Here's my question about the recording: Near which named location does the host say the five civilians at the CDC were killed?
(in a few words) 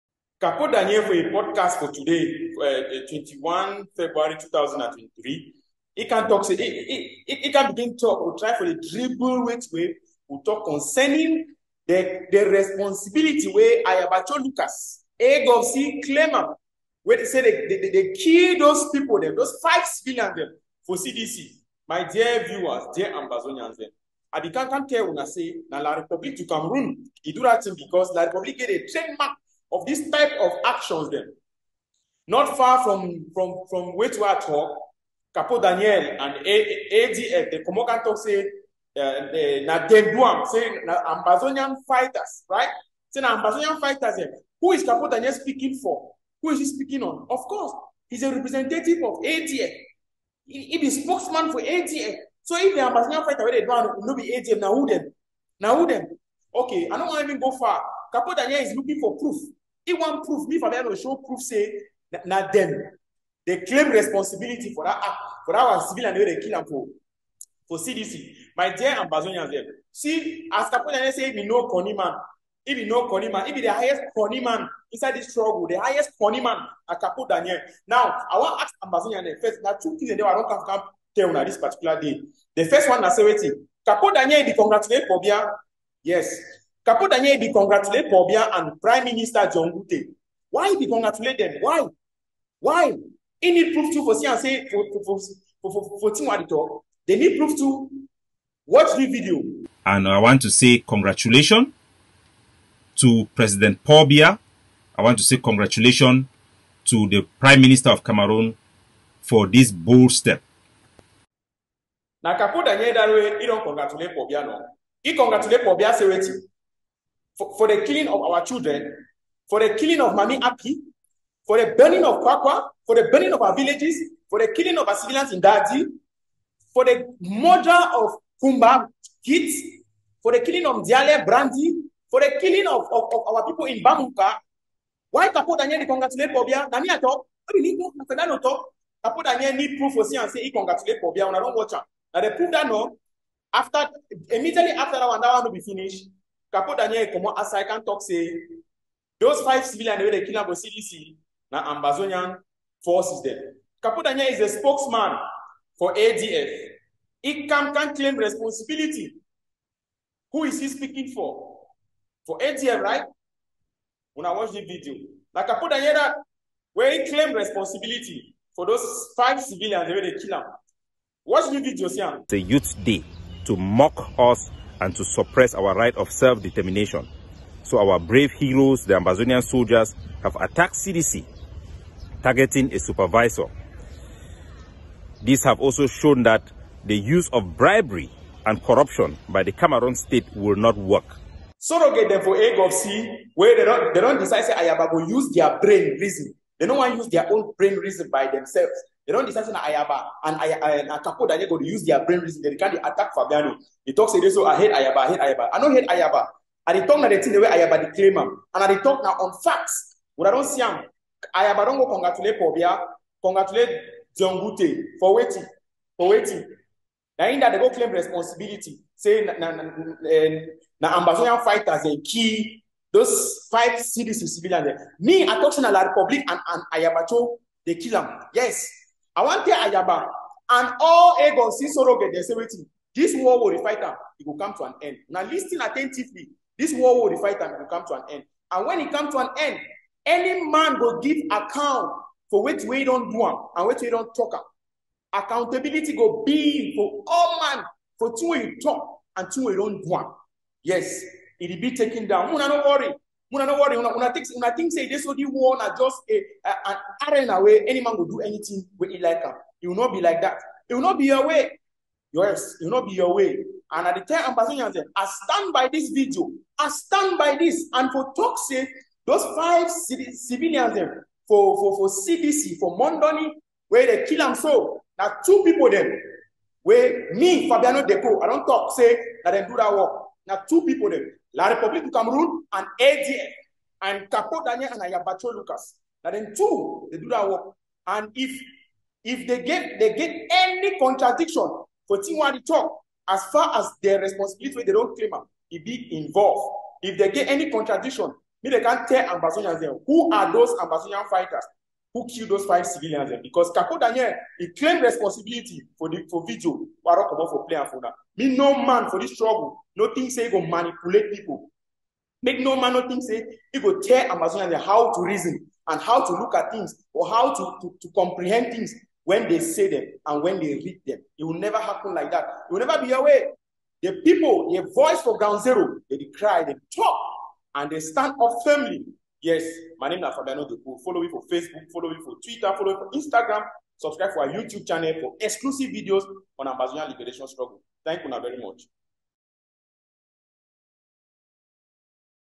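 Mondoni.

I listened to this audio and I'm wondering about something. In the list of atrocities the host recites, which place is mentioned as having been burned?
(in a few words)
Kwakwa.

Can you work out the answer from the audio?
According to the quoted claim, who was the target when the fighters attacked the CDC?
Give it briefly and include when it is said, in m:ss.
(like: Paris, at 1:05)
a supervisor, at 3:02.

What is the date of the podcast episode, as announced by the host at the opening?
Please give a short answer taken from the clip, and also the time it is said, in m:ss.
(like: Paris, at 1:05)
21 February 2023, at 0:03.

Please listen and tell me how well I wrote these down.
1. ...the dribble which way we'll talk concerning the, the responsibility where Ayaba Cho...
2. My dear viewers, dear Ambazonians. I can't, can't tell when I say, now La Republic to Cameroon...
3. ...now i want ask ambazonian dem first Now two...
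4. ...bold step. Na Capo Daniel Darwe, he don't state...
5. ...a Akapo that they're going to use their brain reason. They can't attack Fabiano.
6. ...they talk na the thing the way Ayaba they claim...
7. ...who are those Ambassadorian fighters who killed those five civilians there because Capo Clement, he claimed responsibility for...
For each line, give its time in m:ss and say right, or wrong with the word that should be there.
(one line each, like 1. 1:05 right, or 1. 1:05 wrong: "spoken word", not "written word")
1. 0:08 right
2. 0:21 right
3. 1:17 right
4. 1:49 wrong: "congratulate", not "state"
5. 3:20 right
6. 3:26 right
7. 4:59 wrong: "Daniel", not "Clement".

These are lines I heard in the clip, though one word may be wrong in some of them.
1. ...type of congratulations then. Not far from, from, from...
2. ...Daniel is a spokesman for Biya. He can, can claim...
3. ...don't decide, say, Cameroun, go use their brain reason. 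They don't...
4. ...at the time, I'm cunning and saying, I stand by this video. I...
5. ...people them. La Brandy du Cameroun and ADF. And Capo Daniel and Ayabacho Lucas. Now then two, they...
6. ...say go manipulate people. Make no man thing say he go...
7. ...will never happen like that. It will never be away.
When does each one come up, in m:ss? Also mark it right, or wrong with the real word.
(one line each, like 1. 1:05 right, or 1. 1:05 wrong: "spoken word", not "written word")
1. 0:30 wrong: "actions", not "congratulations"
2. 2:34 wrong: "ADF", not "Biya"
3. 3:14 wrong: "Ayaba", not "Cameroun"
4. 4:23 wrong: "passing", not "cunning"
5. 4:40 wrong: "République", not "Brandy"
6. 5:10 right
7. 5:21 right.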